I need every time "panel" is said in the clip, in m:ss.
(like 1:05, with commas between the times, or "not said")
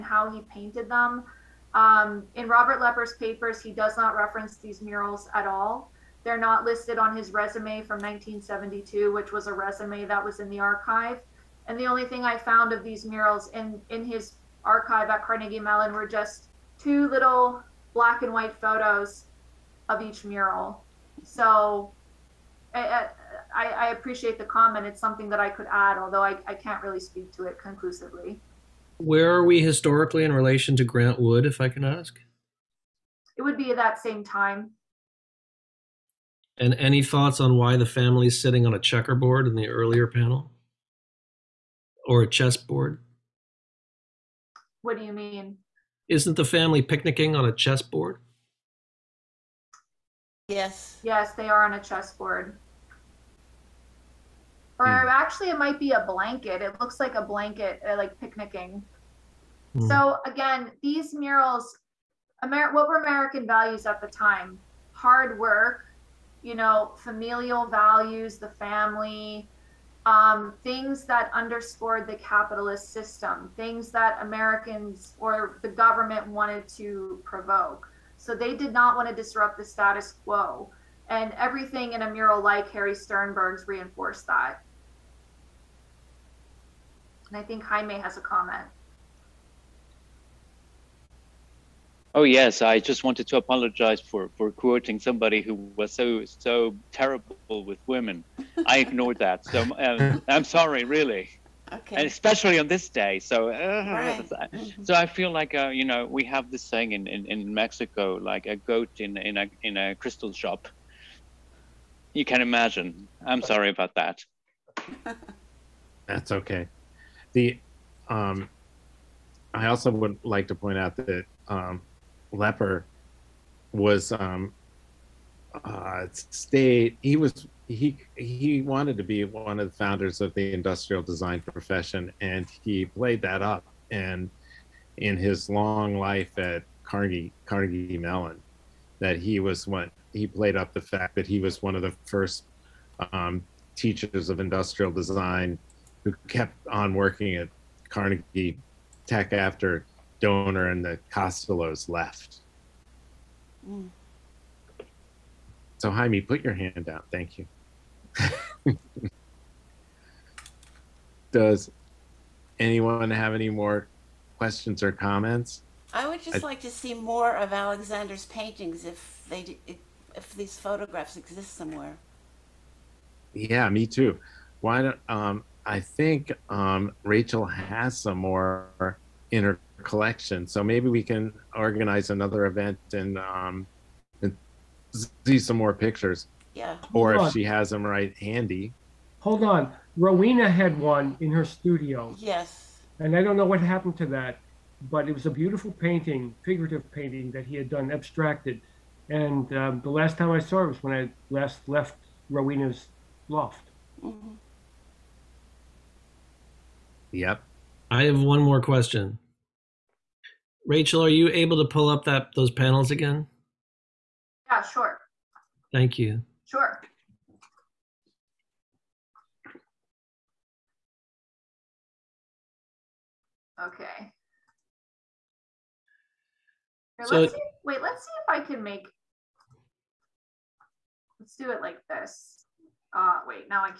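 0:40, 3:32.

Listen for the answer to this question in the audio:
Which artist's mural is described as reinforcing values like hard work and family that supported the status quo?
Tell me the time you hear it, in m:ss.
1:22.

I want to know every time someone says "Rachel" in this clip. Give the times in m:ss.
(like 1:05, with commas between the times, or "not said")
2:57, 3:30.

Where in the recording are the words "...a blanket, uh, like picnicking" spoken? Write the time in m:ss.
0:57.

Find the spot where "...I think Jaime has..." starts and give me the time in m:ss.
1:27.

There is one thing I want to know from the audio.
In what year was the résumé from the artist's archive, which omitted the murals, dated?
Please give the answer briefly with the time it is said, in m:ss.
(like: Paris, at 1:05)
1972, at 0:07.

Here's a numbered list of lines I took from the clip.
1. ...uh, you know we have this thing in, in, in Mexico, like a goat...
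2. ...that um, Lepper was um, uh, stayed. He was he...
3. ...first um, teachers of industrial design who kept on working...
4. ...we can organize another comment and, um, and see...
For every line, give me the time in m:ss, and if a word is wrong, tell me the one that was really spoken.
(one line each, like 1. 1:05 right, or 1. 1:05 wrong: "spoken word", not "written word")
1. 1:45 right
2. 2:00 right
3. 2:22 right
4. 3:00 wrong: "event", not "comment".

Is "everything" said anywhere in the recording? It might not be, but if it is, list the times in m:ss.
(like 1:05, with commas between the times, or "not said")
1:21.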